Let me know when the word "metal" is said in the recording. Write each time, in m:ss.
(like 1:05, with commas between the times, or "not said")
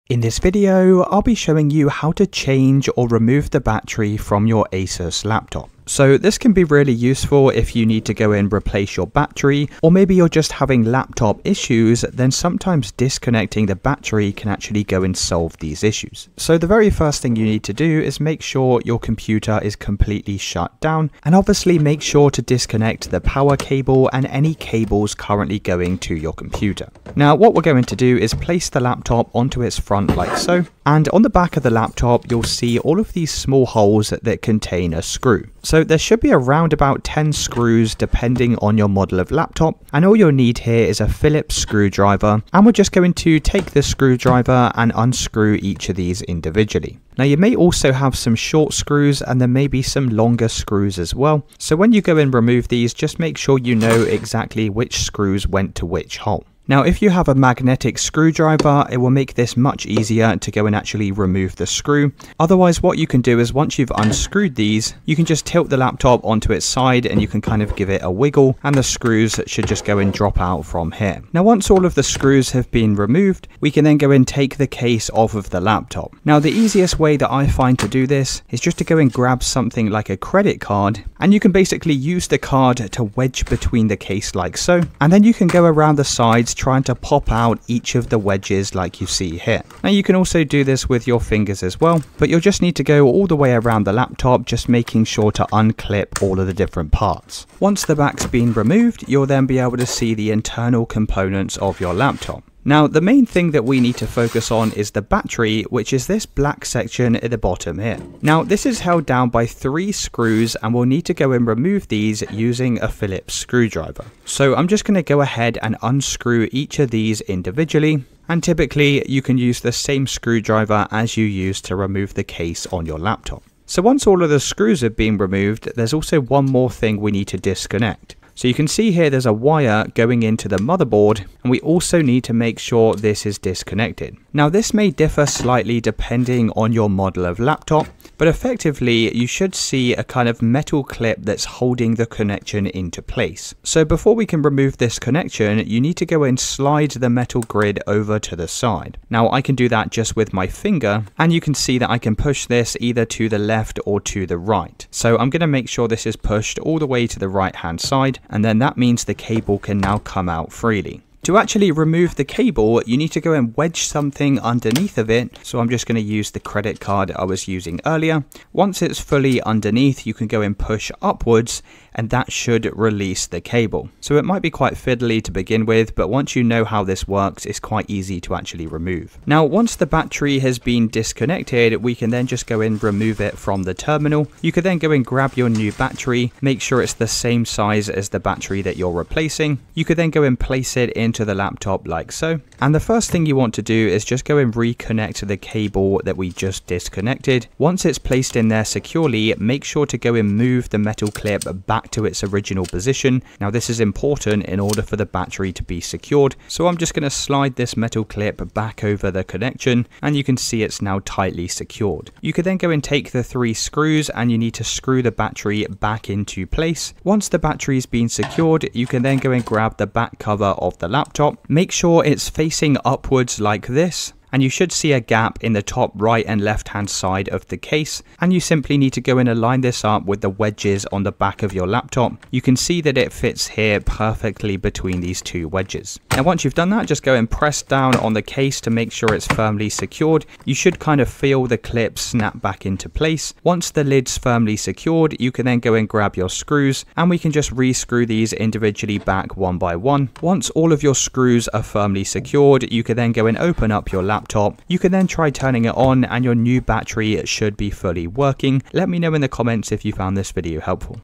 2:20, 2:27, 3:20, 3:27.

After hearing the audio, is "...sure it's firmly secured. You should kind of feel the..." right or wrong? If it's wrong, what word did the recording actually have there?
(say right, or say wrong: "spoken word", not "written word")
right.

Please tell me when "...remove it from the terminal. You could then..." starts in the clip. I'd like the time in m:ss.
3:02.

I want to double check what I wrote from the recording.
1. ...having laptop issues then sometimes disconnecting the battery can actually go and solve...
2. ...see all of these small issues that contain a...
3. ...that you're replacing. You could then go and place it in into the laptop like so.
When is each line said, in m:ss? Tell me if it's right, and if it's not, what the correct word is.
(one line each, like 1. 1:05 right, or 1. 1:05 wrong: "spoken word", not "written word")
1. 0:10 right
2. 0:32 wrong: "holes", not "issues"
3. 3:08 right.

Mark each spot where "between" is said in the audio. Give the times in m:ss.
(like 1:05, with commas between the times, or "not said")
1:23, 3:54.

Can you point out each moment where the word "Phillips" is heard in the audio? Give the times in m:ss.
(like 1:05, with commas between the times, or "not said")
0:41, 1:52.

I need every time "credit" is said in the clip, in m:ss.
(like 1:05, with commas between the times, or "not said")
1:20, 2:46.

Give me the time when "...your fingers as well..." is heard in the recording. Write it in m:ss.
1:31.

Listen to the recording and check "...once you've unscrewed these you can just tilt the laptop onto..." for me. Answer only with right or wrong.
right.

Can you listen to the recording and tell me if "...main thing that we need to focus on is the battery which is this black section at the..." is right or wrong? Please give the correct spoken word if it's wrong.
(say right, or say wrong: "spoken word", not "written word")
right.